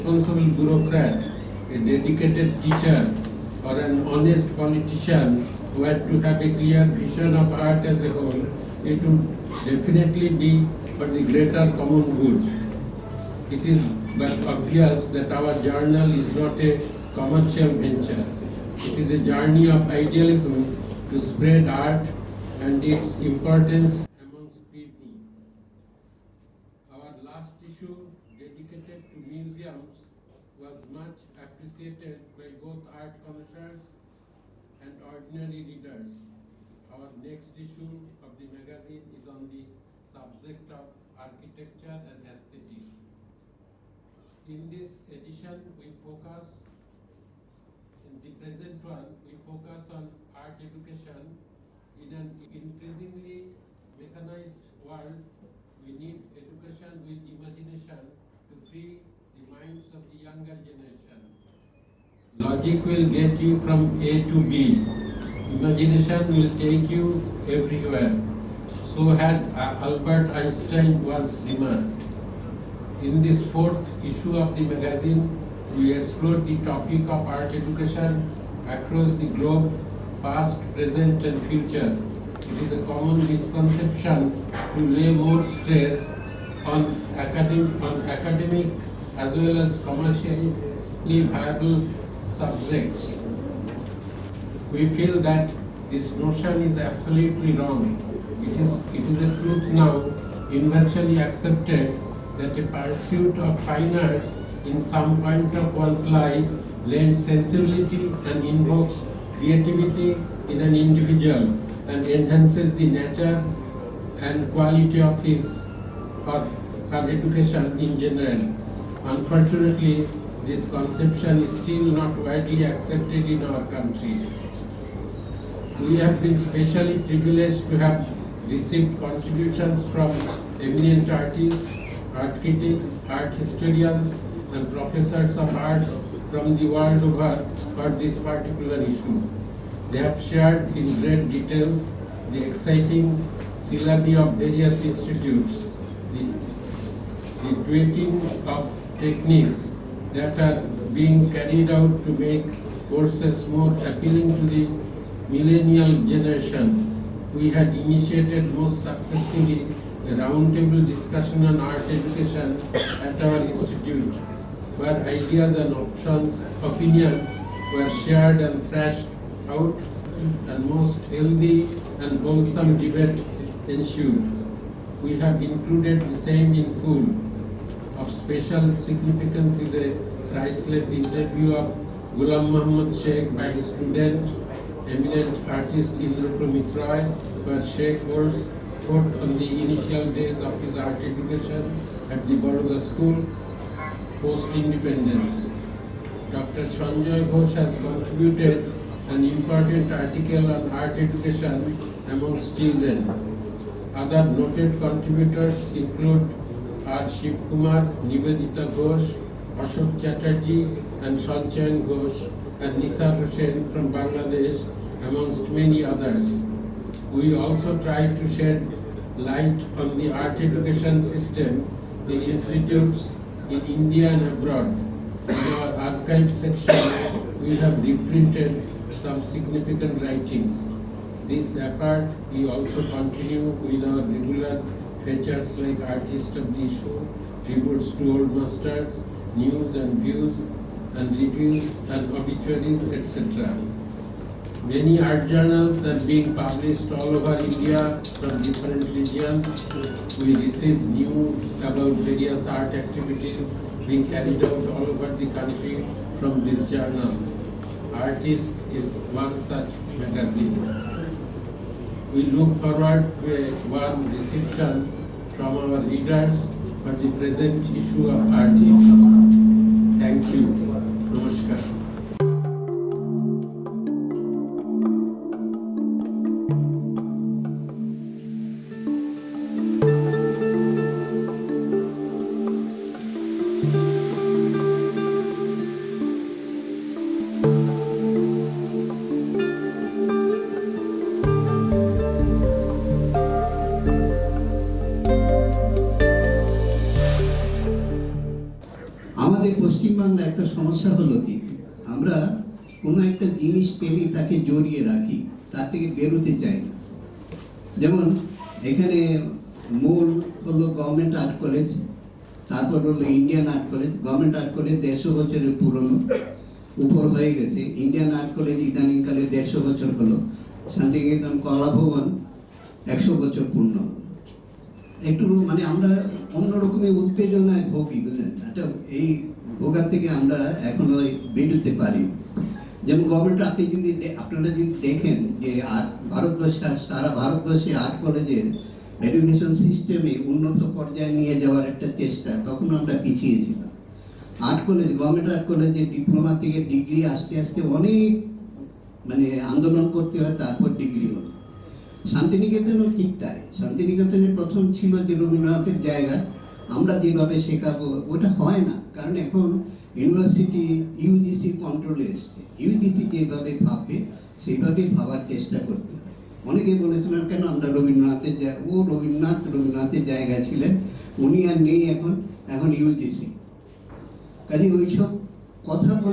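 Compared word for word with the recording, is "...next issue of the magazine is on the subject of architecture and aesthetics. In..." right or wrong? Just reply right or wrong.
right.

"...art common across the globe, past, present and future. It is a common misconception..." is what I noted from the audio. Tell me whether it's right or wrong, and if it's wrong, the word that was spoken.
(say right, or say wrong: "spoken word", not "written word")
wrong: "education", not "common".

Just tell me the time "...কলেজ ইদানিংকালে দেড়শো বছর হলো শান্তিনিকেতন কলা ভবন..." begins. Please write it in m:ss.
5:18.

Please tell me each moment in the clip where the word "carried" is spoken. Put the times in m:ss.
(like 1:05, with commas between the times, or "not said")
2:31, 4:14.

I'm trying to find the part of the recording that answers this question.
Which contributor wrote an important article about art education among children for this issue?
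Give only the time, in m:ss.
3:16.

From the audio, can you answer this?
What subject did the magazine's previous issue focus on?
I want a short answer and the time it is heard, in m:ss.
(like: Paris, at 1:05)
museums, at 0:29.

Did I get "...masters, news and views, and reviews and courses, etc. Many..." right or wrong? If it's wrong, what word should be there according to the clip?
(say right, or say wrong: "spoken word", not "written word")
wrong: "obituaries", not "courses".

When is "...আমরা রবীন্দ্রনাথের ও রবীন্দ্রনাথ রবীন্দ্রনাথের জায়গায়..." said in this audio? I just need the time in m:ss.
6:07.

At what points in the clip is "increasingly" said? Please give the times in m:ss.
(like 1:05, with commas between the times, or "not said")
0:52.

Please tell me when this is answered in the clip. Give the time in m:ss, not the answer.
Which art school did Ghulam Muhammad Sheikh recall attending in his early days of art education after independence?
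3:12.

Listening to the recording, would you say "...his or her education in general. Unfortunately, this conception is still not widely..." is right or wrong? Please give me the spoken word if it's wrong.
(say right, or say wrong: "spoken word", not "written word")
right.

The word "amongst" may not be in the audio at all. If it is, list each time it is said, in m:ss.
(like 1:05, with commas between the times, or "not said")
0:24, 3:22, 3:35.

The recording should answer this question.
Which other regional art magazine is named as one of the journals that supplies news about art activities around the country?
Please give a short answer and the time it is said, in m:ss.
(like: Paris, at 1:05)
ArtEast, at 4:18.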